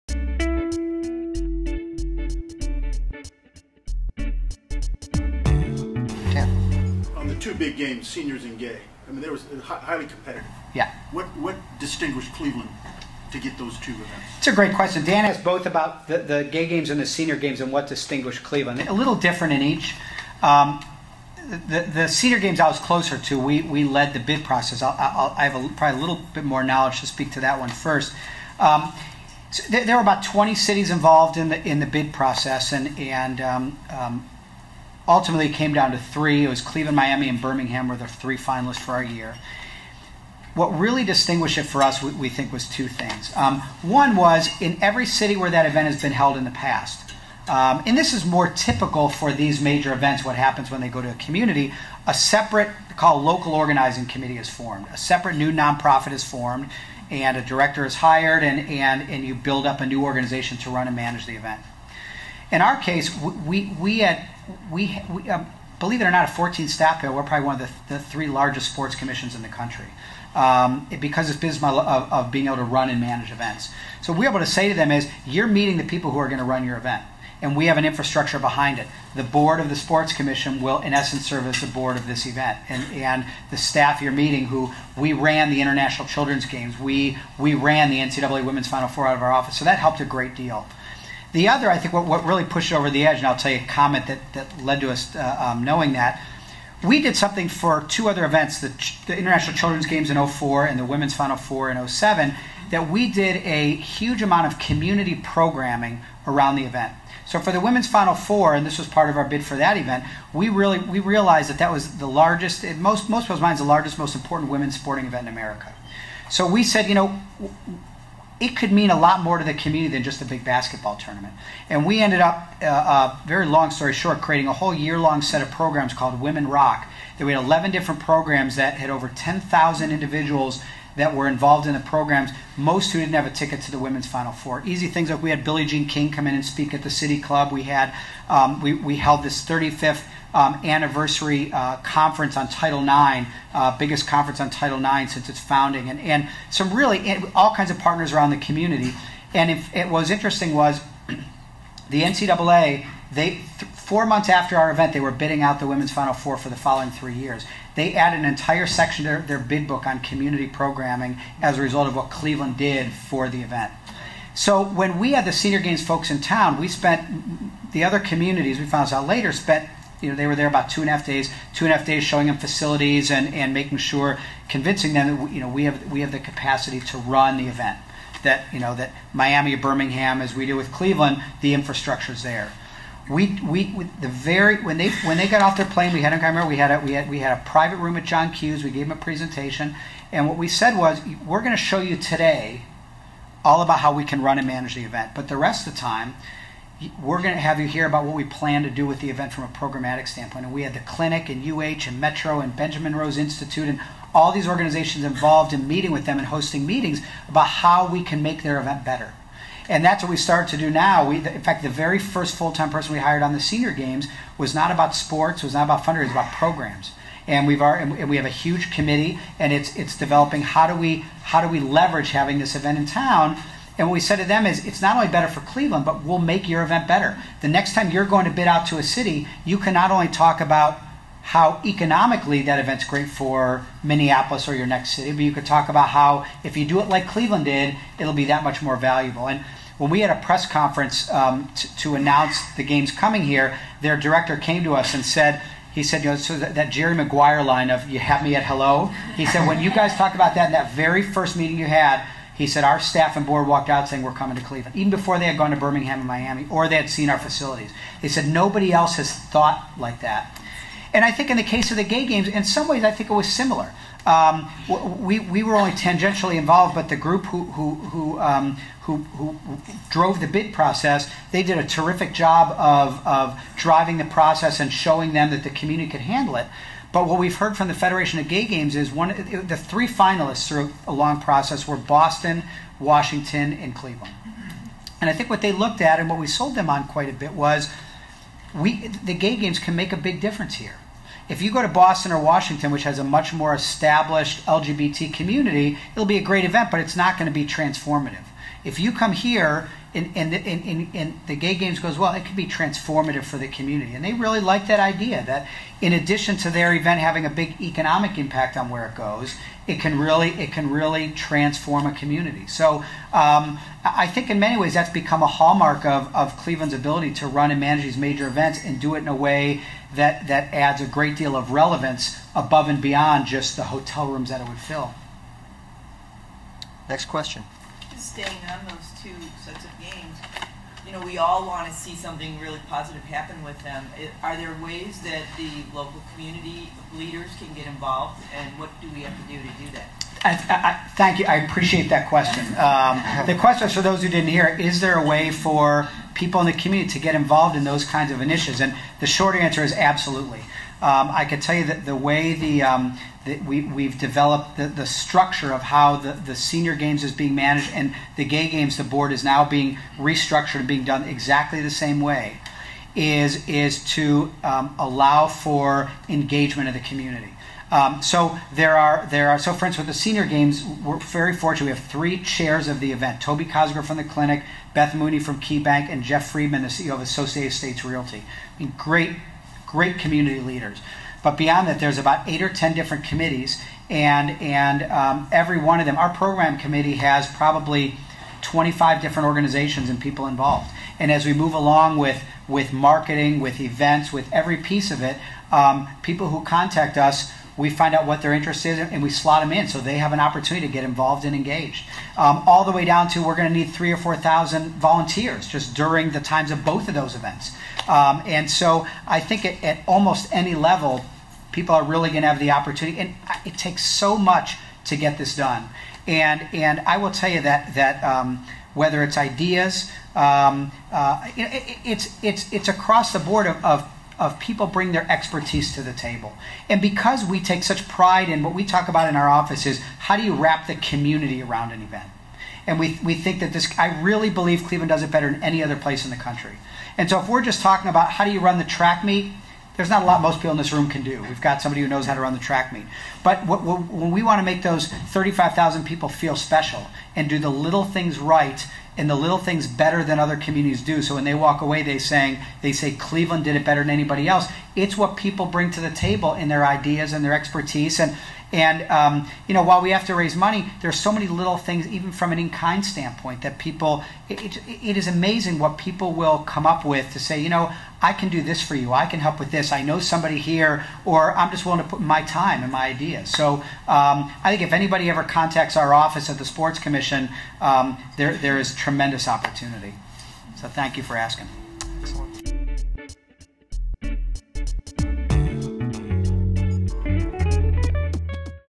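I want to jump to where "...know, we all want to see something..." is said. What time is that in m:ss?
5:30.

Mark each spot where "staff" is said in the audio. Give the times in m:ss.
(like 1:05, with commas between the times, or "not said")
1:06, 1:23, 4:12.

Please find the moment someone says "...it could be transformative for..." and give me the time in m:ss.
5:02.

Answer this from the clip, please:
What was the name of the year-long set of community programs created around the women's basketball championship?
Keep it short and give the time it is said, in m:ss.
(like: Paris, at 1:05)
Women Rock, at 2:06.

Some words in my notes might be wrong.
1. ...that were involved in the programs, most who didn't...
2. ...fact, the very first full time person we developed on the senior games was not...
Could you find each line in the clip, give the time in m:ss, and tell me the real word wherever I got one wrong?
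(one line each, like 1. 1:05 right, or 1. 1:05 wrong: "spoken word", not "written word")
1. 2:10 right
2. 3:31 wrong: "hired", not "developed".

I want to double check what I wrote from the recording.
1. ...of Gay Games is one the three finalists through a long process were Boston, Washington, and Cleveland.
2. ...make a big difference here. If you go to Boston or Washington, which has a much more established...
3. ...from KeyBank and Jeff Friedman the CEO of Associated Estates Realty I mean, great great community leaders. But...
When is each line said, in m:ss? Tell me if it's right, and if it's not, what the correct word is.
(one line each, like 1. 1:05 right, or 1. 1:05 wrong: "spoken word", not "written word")
1. 4:38 right
2. 4:49 right
3. 6:15 right.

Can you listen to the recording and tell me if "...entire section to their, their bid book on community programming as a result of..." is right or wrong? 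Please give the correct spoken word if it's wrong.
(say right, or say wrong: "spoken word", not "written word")
right.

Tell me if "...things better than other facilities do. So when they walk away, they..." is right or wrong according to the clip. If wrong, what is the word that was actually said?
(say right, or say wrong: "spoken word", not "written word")
wrong: "communities", not "facilities".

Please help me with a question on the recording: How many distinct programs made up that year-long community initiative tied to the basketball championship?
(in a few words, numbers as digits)
11.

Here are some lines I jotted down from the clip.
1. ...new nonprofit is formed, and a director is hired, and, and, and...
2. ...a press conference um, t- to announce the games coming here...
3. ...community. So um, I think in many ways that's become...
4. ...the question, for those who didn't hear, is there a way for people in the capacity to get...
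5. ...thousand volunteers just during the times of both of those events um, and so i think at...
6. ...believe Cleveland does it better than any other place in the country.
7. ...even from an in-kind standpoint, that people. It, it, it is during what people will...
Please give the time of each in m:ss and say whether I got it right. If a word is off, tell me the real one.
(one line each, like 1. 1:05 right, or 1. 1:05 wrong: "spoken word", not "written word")
1. 0:55 right
2. 4:00 right
3. 5:11 right
4. 5:43 wrong: "community", not "capacity"
5. 6:44 right
6. 7:14 right
7. 7:41 wrong: "amazing", not "during".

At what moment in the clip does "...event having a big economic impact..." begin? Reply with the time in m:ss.
5:06.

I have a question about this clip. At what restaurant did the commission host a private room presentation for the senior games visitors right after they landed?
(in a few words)
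John Q's.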